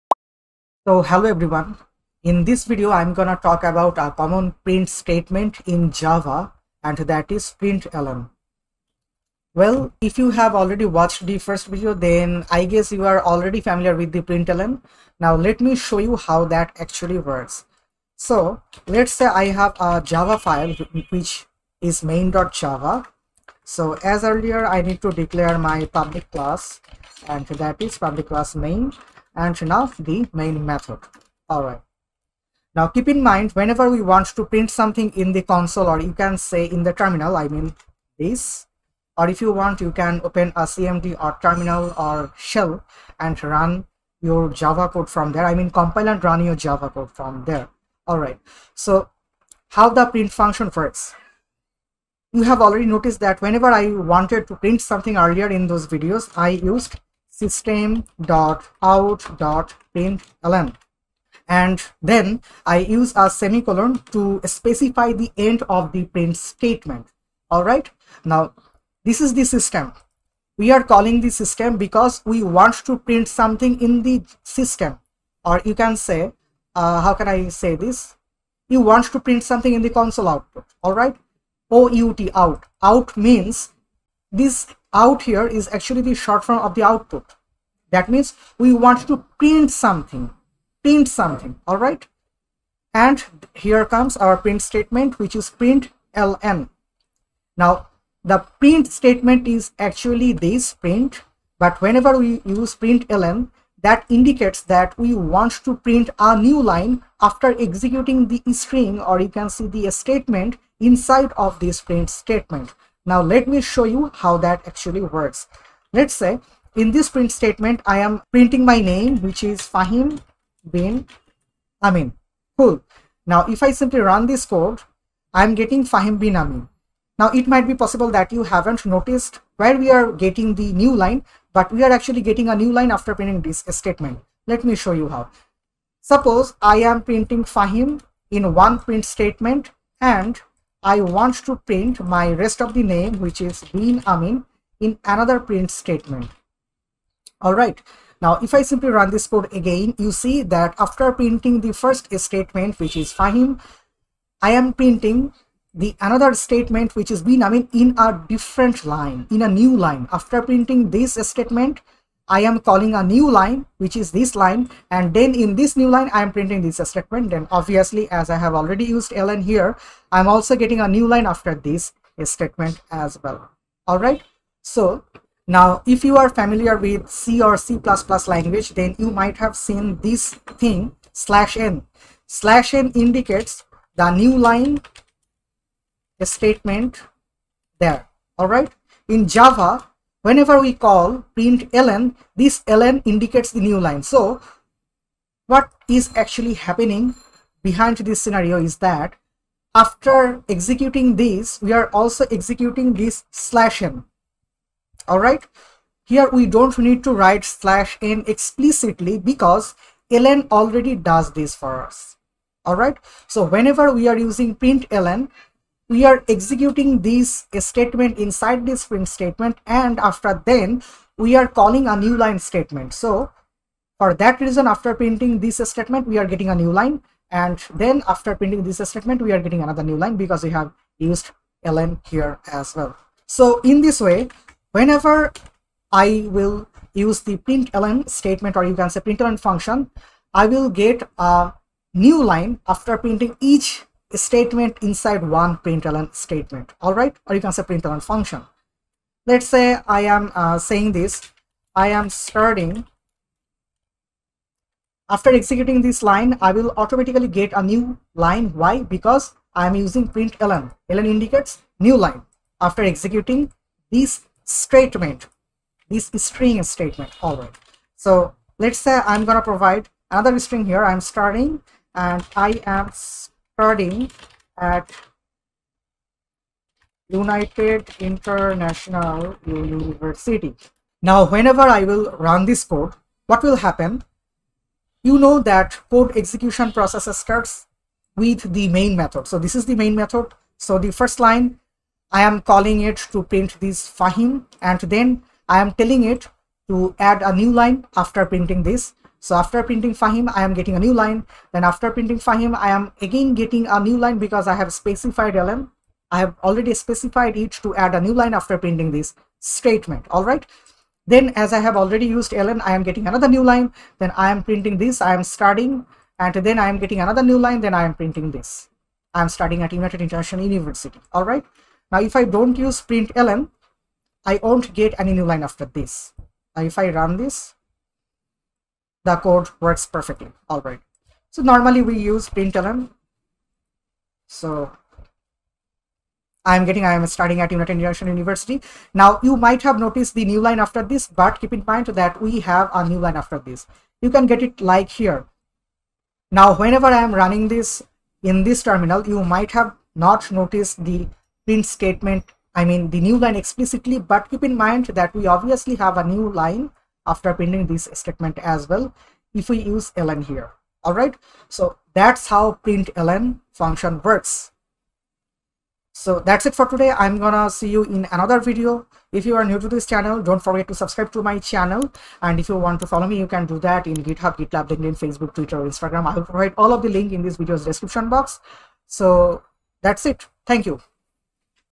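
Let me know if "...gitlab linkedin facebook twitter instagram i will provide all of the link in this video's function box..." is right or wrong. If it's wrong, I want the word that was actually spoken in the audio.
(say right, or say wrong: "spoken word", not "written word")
wrong: "description", not "function".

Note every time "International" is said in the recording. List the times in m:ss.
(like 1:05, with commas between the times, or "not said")
4:37, 5:20, 5:37.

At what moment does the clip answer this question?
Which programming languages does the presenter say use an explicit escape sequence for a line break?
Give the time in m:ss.
2:57.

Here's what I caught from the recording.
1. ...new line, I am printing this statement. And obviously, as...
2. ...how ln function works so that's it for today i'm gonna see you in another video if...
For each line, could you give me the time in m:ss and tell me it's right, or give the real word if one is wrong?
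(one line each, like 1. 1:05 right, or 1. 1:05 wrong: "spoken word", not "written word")
1. 2:45 right
2. 6:02 right.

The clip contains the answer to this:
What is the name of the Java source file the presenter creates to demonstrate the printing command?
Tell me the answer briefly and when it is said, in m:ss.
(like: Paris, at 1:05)
main.java, at 0:22.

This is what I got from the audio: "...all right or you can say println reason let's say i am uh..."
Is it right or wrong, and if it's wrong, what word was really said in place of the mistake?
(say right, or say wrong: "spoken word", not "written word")
wrong: "function", not "reason".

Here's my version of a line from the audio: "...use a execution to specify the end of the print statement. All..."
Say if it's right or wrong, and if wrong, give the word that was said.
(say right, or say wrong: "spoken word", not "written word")
wrong: "semicolon", not "execution".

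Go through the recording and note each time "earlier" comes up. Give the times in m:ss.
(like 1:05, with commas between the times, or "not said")
0:24, 0:55.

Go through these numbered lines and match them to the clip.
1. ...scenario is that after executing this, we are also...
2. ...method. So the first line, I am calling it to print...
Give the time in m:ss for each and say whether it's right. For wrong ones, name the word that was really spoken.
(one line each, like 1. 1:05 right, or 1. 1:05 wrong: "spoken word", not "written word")
1. 3:18 right
2. 4:49 right.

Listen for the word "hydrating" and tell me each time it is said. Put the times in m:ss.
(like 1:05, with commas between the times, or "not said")
not said.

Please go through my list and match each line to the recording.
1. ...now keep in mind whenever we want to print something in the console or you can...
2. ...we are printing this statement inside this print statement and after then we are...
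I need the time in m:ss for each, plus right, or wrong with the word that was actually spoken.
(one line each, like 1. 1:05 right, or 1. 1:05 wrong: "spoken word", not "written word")
1. 0:32 right
2. 3:35 wrong: "executing", not "printing".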